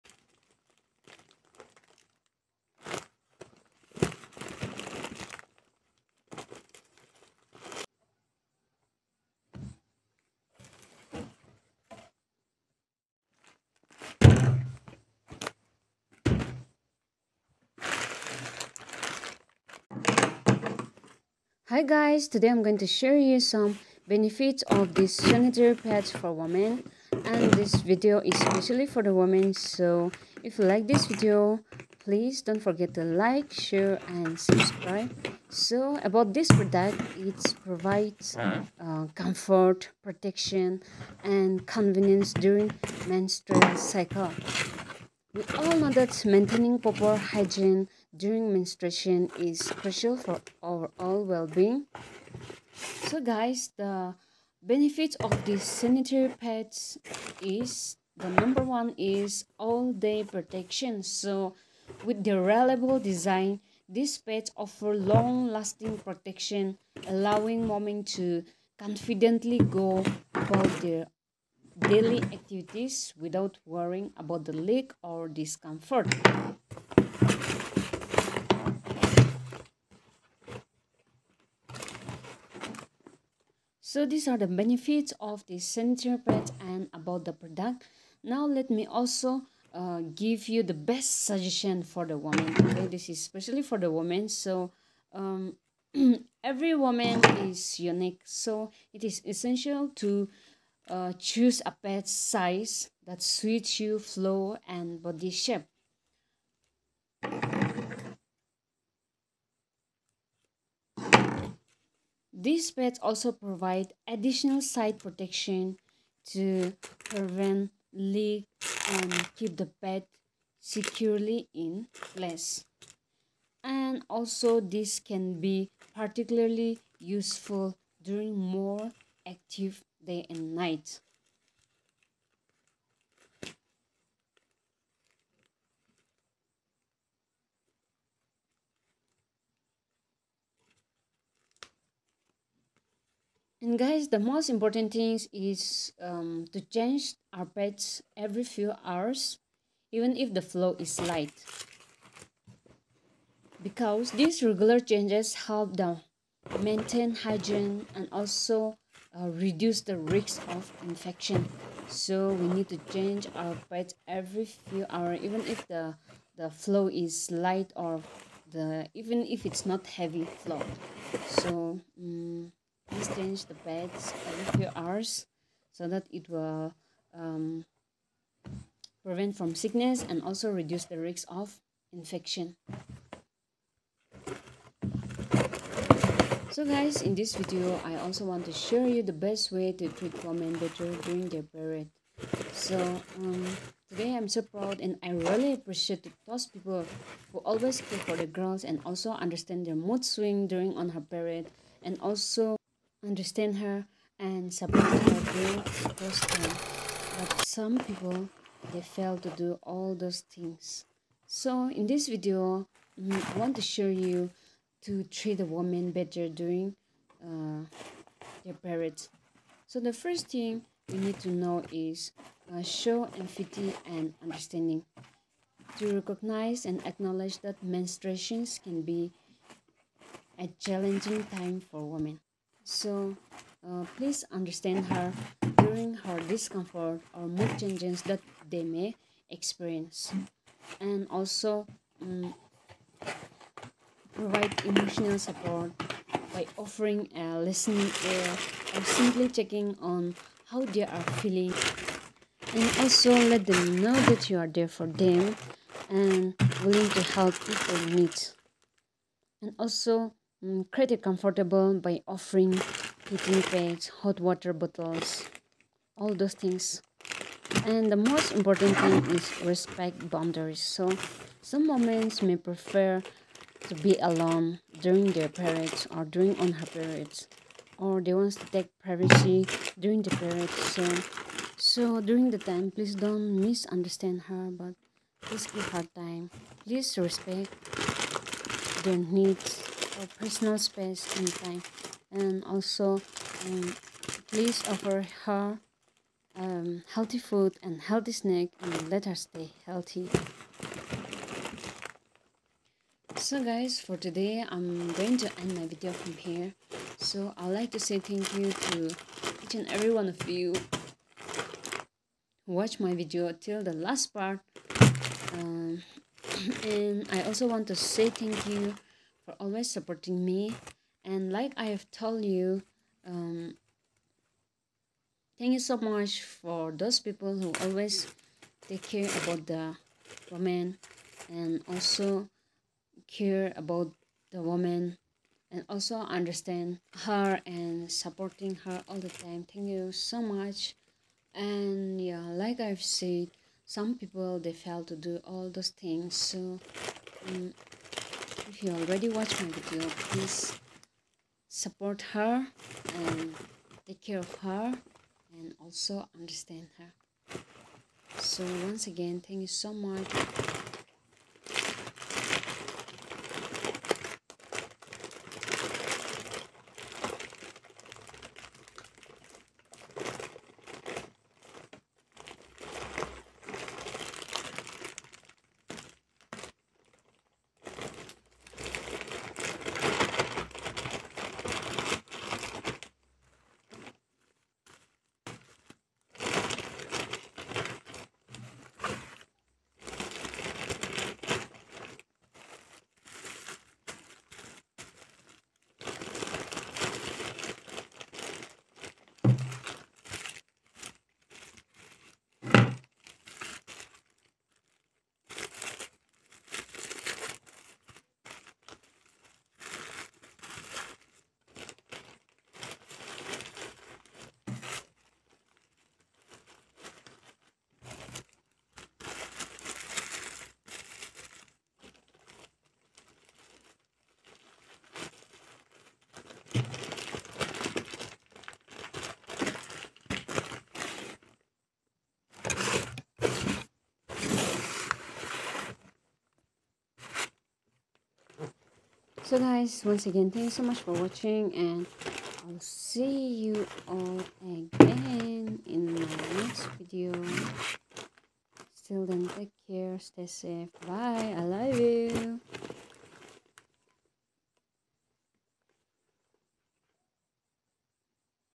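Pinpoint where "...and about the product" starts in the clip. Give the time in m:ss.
1:26.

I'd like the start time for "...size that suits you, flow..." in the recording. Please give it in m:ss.
1:42.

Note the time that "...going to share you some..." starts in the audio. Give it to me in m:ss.
0:22.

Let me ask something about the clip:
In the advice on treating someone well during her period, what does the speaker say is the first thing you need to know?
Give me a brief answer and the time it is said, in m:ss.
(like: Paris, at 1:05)
Show empathy and understanding, at 3:42.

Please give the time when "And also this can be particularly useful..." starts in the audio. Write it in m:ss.
2:03.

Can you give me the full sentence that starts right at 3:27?
But some people they fail to do all those things.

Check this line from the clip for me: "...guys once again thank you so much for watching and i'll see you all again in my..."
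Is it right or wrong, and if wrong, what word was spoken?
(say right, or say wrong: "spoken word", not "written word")
right.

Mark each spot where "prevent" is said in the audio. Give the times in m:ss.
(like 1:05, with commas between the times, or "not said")
1:57, 2:59.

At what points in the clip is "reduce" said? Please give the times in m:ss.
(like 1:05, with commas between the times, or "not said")
2:39, 3:00.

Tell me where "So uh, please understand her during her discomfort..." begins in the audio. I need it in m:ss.
3:52.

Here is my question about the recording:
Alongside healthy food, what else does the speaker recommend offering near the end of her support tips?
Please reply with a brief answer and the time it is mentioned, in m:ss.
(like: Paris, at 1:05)
Healthy snack, at 4:57.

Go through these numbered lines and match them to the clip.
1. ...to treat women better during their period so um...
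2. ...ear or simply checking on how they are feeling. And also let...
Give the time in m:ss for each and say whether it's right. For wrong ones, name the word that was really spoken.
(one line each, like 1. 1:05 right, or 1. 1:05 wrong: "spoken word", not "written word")
1. 3:09 right
2. 4:08 right.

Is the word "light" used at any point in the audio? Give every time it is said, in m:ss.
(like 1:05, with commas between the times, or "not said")
2:30, 2:47.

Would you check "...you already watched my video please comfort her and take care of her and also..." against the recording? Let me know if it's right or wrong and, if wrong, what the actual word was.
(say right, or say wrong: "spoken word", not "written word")
wrong: "support", not "comfort".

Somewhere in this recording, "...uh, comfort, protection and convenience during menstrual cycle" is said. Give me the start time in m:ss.
0:38.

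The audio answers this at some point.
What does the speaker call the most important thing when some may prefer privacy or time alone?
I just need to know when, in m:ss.
4:29.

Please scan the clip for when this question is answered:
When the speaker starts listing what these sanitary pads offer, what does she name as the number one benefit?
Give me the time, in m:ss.
0:59.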